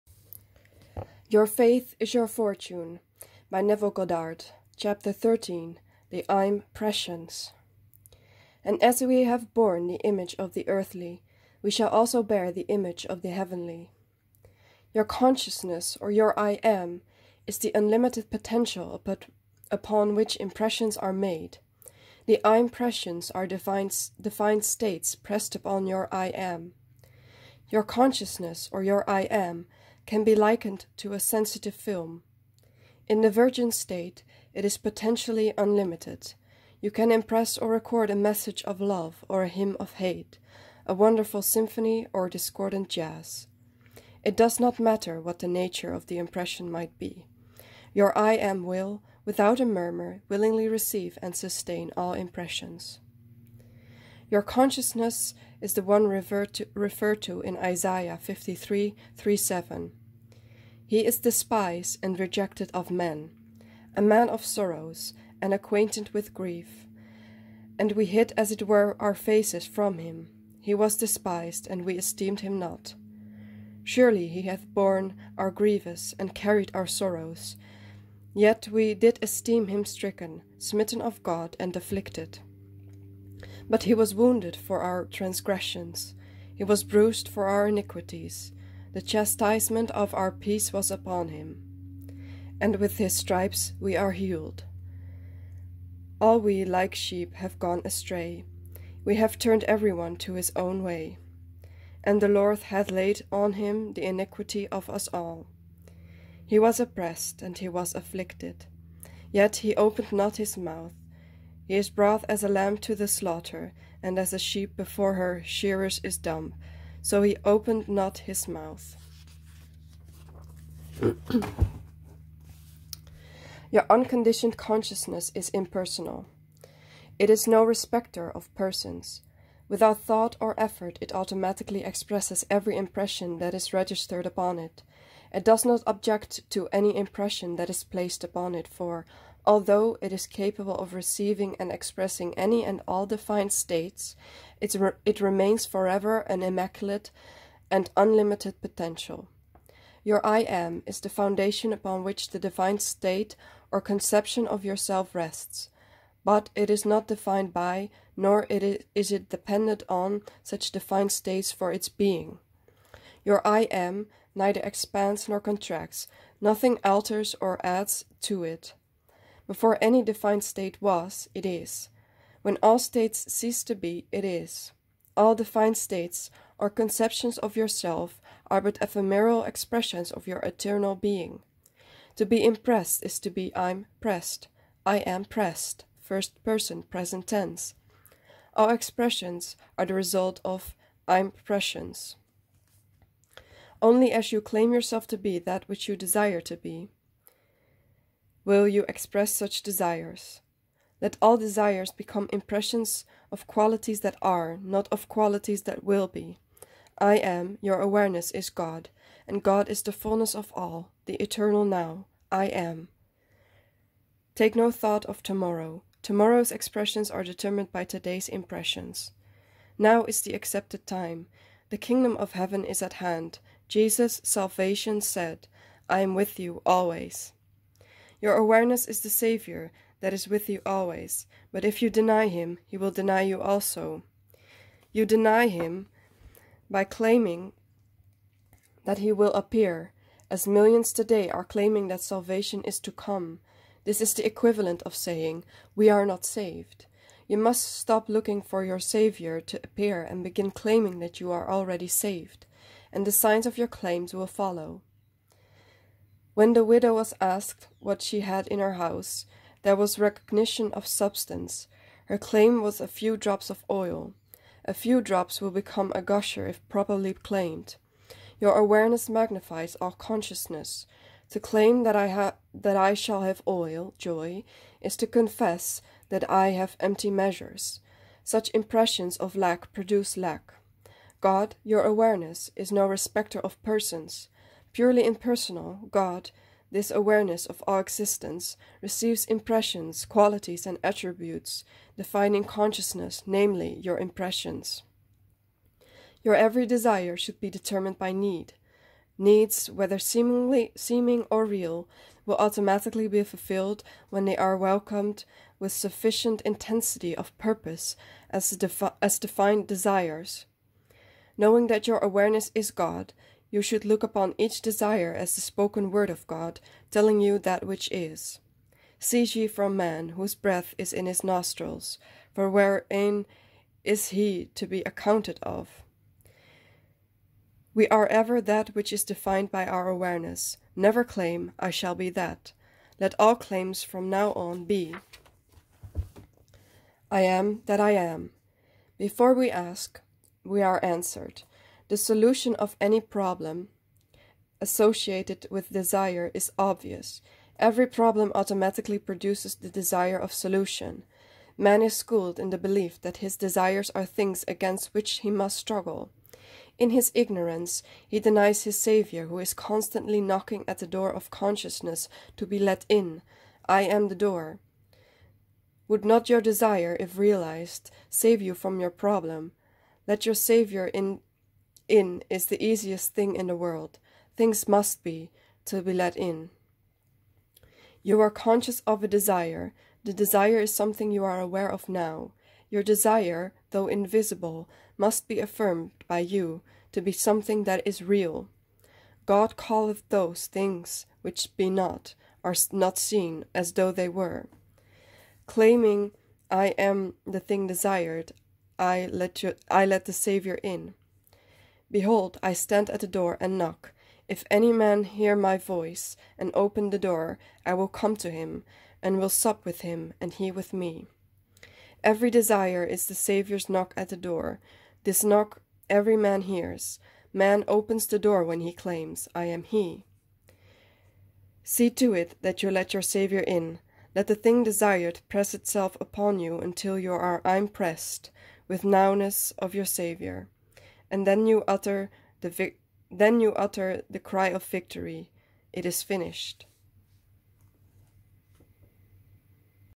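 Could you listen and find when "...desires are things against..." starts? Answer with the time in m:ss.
5:53.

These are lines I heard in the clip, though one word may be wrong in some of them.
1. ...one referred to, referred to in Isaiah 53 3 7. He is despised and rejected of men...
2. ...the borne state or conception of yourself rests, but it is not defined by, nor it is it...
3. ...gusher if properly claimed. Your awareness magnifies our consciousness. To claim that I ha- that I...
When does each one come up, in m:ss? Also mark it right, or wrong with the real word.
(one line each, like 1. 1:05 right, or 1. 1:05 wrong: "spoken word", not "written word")
1. 0:55 right
2. 2:32 wrong: "divine", not "borne"
3. 4:26 right.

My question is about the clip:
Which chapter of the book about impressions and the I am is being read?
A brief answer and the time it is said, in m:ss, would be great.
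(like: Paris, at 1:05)
13, at 0:05.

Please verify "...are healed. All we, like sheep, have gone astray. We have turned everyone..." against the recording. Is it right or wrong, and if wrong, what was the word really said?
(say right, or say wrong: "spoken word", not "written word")
right.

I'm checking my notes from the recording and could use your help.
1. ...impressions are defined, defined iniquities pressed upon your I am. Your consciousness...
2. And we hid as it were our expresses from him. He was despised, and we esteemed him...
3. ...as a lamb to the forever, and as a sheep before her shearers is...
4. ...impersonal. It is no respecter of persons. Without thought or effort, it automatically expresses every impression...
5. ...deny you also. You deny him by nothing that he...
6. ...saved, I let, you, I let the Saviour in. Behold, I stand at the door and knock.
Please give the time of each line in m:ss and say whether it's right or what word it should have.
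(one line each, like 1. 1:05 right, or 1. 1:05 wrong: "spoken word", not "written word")
1. 0:22 wrong: "states", not "iniquities"
2. 1:07 wrong: "faces", not "expresses"
3. 1:52 wrong: "slaughter", not "forever"
4. 2:05 right
5. 3:52 wrong: "claiming", not "nothing"
6. 6:37 wrong: "desired", not "saved".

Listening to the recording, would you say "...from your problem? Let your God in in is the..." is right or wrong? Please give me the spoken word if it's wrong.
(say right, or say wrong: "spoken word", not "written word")
wrong: "Saviour", not "God".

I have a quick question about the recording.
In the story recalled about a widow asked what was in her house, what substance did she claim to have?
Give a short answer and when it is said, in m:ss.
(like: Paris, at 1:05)
a few drops of oil, at 4:22.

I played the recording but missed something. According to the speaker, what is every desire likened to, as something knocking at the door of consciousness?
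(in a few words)
the Saviour's knock.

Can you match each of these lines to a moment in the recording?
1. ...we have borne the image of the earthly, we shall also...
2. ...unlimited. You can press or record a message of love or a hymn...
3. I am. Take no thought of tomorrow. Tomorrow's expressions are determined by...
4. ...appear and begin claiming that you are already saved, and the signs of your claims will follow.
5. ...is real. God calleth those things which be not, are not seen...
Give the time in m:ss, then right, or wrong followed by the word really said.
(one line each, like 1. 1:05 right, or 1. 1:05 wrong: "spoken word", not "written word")
1. 0:09 right
2. 0:35 wrong: "impress", not "press"
3. 3:32 right
4. 4:09 right
5. 6:27 right.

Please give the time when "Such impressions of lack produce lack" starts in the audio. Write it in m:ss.
4:38.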